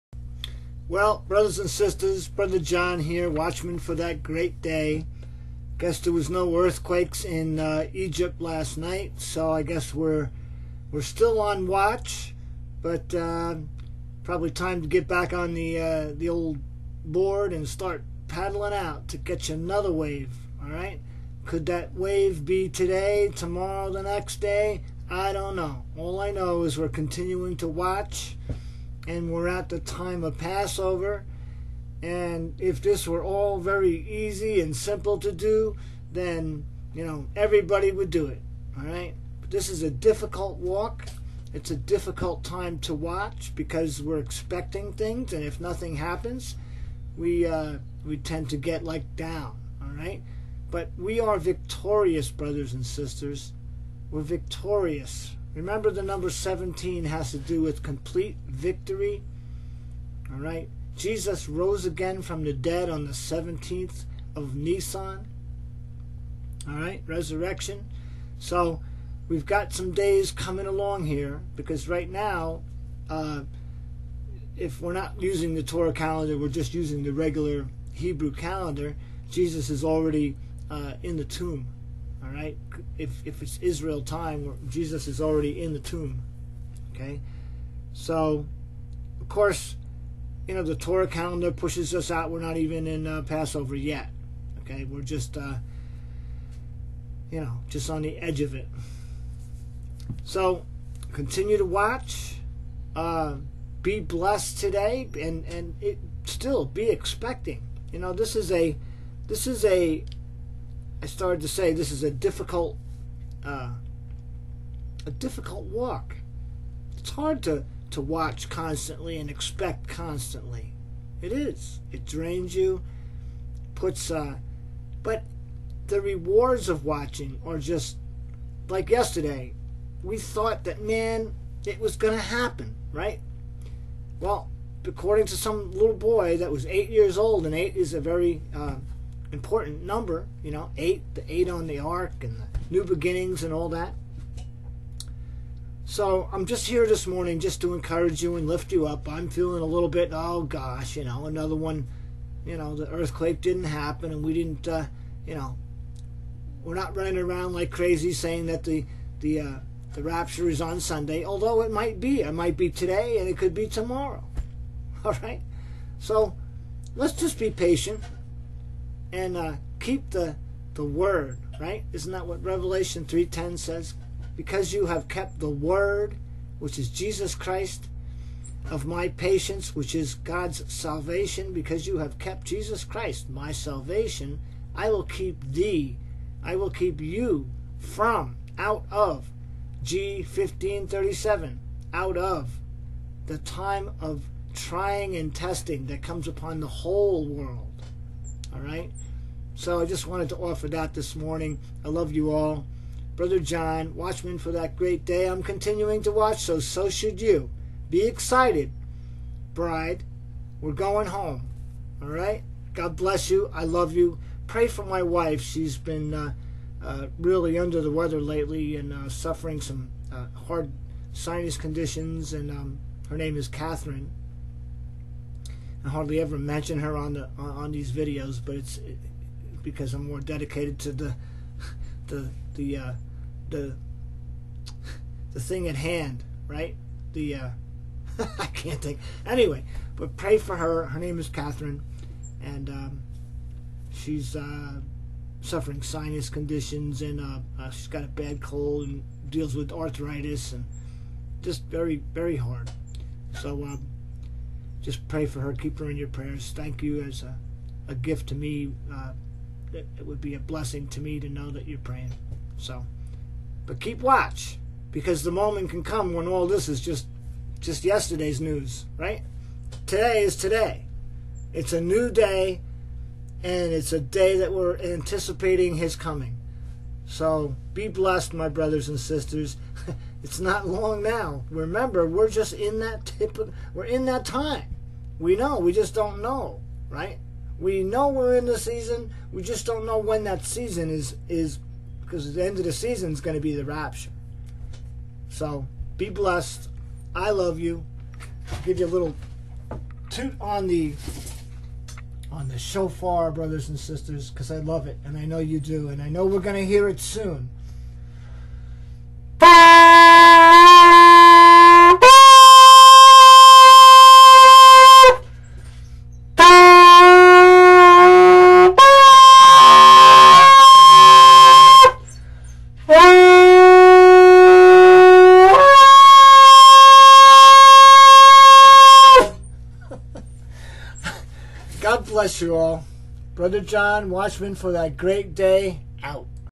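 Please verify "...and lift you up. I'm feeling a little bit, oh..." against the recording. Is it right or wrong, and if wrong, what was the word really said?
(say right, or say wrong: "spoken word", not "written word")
right.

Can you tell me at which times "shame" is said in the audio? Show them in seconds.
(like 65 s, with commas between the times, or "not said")
not said.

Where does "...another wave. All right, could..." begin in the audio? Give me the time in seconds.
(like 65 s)
19 s.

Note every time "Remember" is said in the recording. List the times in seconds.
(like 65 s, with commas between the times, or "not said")
55 s, 281 s.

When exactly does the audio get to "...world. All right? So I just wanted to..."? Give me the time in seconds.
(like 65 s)
197 s.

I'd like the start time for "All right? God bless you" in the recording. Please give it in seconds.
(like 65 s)
212 s.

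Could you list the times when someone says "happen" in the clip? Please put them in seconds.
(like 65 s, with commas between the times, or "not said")
45 s, 132 s, 153 s.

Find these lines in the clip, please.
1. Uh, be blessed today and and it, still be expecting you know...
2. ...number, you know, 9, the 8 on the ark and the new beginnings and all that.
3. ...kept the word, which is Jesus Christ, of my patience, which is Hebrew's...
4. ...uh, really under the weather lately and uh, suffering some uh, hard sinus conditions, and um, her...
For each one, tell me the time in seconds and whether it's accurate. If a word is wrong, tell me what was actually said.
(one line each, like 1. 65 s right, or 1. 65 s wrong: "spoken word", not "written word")
1. 102 s right
2. 139 s wrong: "8", not "9"
3. 175 s wrong: "God", not "Hebrew"
4. 216 s right.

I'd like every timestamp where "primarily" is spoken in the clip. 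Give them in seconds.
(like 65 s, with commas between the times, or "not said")
not said.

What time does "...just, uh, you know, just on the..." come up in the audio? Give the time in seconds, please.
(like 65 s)
95 s.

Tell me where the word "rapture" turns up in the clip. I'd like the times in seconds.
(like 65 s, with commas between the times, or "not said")
160 s, 293 s.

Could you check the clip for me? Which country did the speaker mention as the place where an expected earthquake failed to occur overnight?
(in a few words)
Egypt.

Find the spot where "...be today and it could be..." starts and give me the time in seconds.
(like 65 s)
162 s.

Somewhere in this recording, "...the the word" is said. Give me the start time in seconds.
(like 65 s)
170 s.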